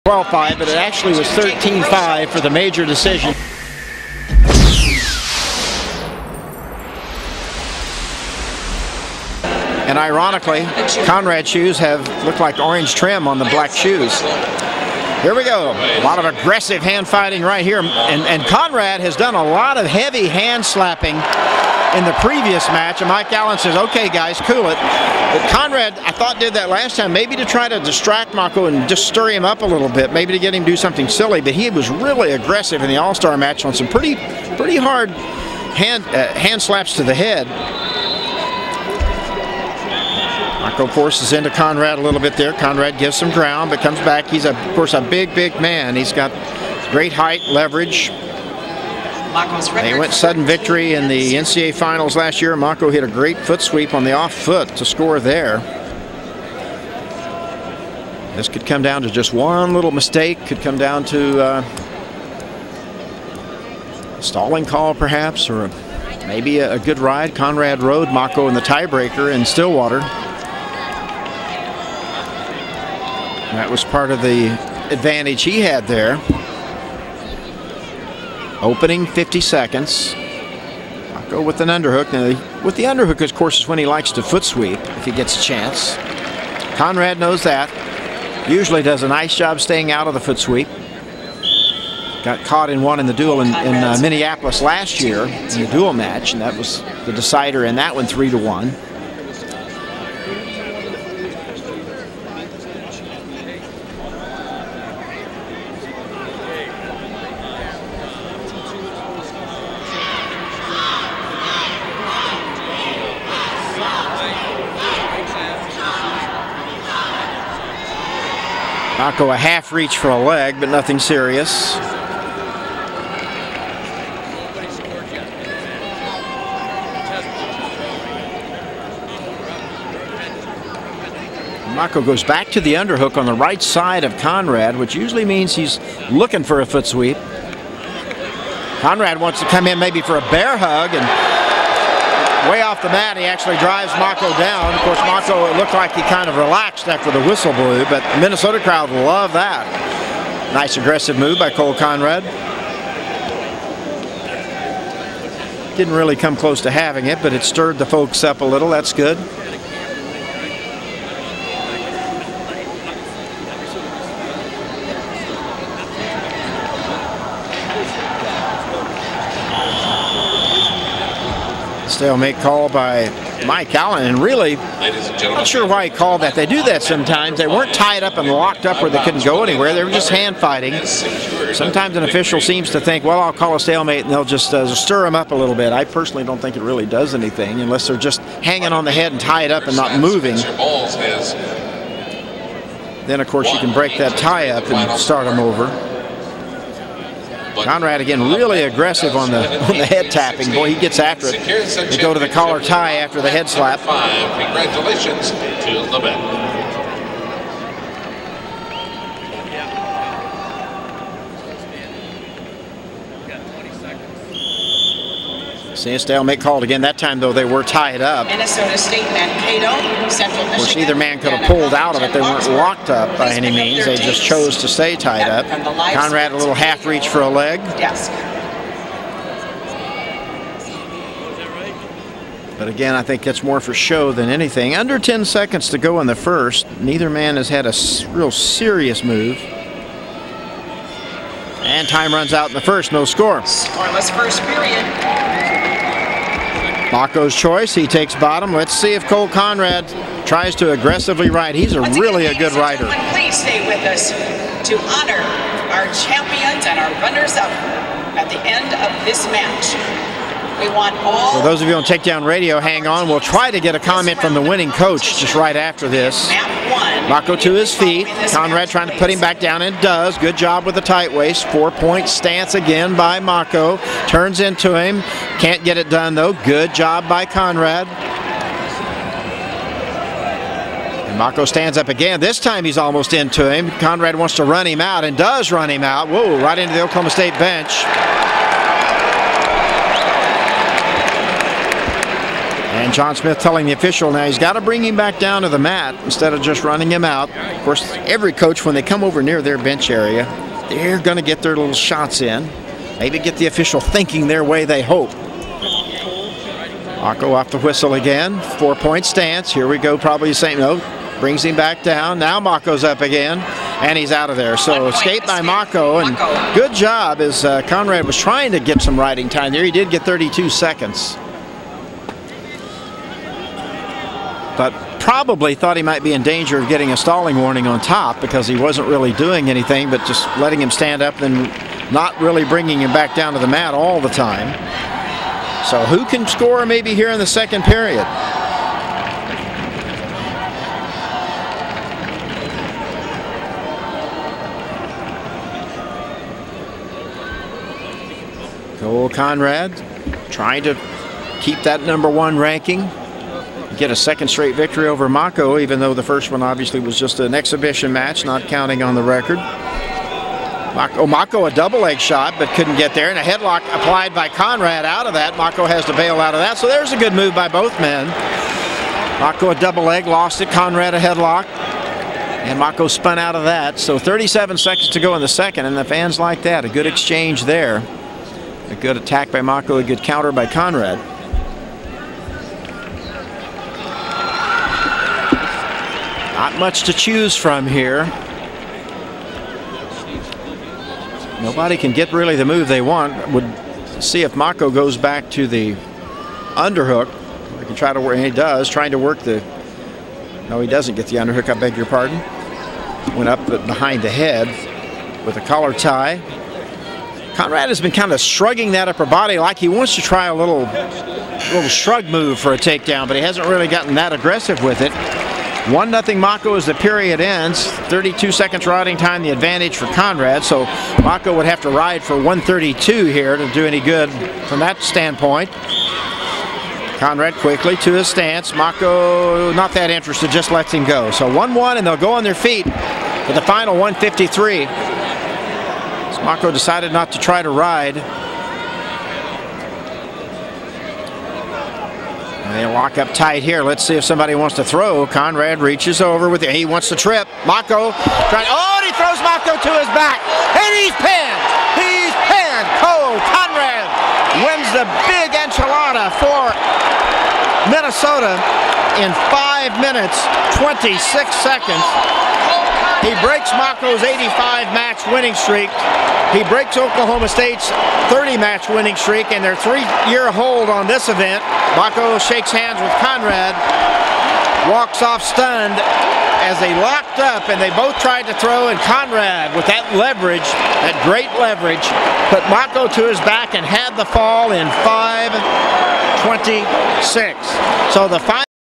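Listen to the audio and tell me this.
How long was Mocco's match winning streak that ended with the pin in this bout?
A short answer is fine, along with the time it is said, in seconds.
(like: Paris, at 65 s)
85 matches, at 464 s.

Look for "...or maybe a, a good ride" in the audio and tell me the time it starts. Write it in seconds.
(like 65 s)
65 s.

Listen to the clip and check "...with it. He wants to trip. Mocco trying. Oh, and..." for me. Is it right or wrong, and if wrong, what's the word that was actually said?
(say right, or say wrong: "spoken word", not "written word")
right.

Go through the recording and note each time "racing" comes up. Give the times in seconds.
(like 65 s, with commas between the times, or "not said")
not said.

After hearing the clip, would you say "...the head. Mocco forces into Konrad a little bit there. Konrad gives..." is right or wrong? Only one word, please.
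right.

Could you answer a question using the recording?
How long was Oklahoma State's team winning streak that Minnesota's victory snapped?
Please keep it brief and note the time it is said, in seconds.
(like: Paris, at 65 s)
30 matches, at 468 s.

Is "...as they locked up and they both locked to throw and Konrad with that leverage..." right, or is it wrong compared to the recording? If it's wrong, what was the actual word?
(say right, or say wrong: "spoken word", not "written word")
wrong: "tried", not "locked".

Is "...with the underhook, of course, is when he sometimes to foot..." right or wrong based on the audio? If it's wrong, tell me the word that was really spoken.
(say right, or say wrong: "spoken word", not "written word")
wrong: "likes", not "sometimes".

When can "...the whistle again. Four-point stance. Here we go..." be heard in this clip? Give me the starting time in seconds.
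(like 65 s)
307 s.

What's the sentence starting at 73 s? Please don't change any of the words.
That was part of the advantage he had there.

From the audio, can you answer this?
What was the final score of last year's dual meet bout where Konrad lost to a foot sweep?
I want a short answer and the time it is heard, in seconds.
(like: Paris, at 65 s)
3-1, at 98 s.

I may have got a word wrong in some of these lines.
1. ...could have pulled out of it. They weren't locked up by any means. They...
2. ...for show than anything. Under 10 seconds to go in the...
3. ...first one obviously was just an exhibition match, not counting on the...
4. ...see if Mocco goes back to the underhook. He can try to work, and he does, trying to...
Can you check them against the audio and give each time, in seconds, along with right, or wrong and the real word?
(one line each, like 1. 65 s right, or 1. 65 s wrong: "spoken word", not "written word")
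1. 221 s right
2. 233 s right
3. 356 s right
4. 394 s right.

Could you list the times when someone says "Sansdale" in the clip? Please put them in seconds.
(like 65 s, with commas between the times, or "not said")
215 s.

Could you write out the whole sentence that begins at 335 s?
So who can score maybe here in the second period?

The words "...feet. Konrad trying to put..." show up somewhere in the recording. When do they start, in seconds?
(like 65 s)
267 s.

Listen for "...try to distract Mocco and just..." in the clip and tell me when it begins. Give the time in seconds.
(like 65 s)
27 s.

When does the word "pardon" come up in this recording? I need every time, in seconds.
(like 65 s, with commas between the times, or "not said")
401 s.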